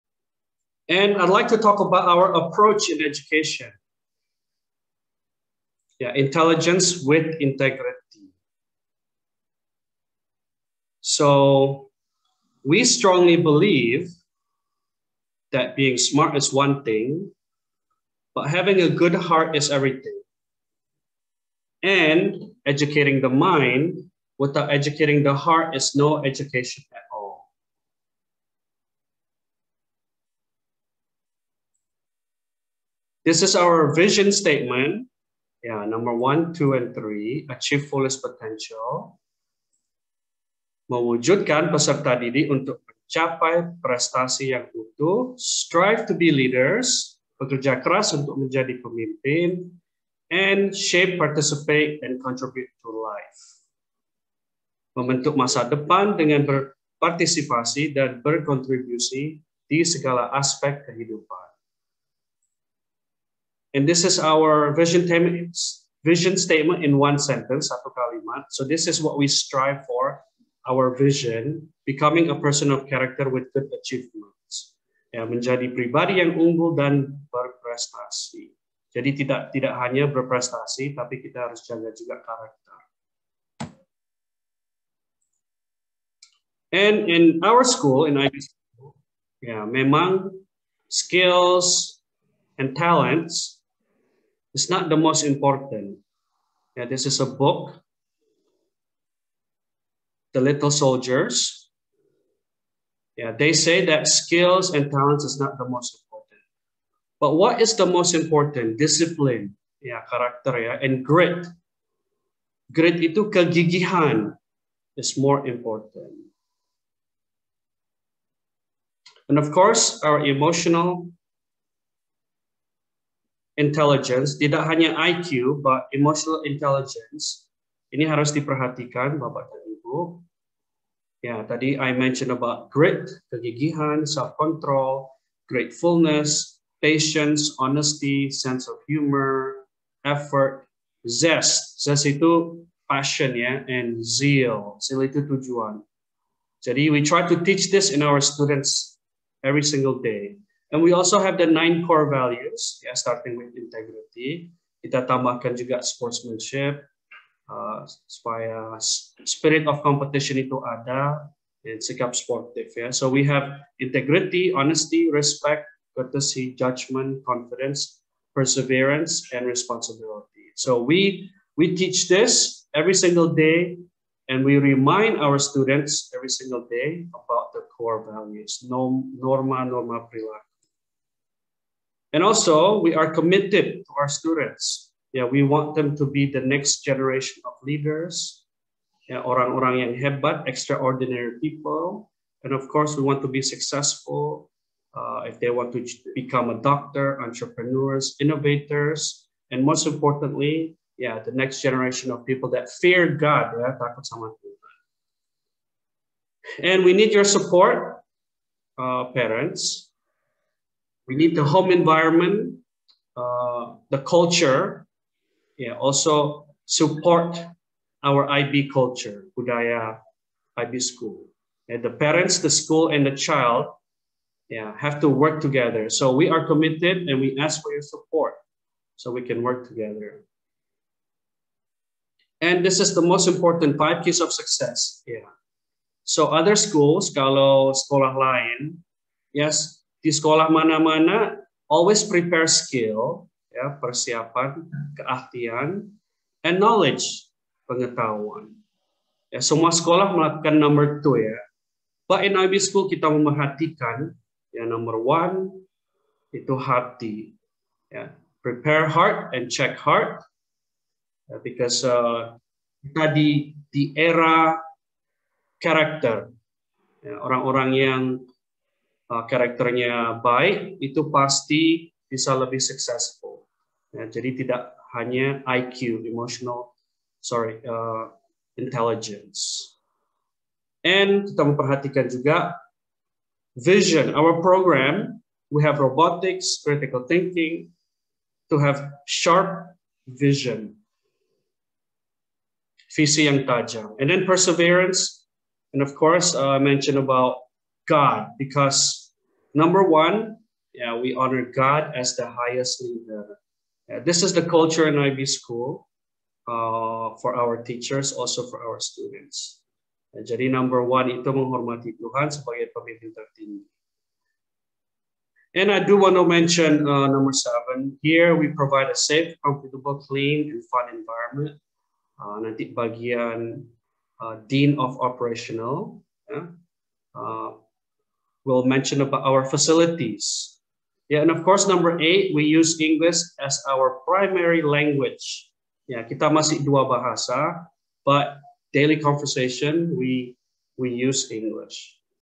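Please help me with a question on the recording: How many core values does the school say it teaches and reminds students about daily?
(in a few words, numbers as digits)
9.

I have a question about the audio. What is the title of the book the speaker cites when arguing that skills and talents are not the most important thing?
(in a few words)
The Little Soldiers.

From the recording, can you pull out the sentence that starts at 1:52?
Grit itu kegigihan is more important.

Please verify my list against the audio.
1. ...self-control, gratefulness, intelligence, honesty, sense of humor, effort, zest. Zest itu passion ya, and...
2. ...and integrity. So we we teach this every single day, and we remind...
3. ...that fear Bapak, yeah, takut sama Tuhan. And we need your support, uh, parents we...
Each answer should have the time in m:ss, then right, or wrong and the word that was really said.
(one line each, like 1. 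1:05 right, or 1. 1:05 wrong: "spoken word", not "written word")
1. 2:14 wrong: "patience", not "intelligence"
2. 2:49 wrong: "responsibility", not "integrity"
3. 3:22 wrong: "God", not "Bapak".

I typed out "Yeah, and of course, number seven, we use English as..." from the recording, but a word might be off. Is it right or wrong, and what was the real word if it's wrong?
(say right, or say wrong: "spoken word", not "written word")
wrong: "eight", not "seven".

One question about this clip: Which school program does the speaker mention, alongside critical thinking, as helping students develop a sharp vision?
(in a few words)
Robotics.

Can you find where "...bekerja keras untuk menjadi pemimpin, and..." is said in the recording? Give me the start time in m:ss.
0:47.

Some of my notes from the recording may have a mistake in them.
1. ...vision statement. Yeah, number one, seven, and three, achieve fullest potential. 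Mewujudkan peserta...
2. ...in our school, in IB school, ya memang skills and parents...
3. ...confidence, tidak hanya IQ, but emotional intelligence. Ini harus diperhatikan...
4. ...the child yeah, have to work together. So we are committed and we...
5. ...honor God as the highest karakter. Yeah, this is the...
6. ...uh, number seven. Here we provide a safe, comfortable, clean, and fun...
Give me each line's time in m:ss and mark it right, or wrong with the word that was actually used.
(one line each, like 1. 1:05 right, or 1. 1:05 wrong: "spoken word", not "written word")
1. 0:33 wrong: "two", not "seven"
2. 1:27 wrong: "talents", not "parents"
3. 2:03 wrong: "intelligence", not "confidence"
4. 3:43 right
5. 5:01 wrong: "leader", not "karakter"
6. 5:16 right.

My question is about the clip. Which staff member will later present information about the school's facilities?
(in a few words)
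Dean of Operational.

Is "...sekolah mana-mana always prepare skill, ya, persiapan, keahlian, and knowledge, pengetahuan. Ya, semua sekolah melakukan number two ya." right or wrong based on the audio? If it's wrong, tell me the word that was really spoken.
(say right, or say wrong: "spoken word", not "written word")
right.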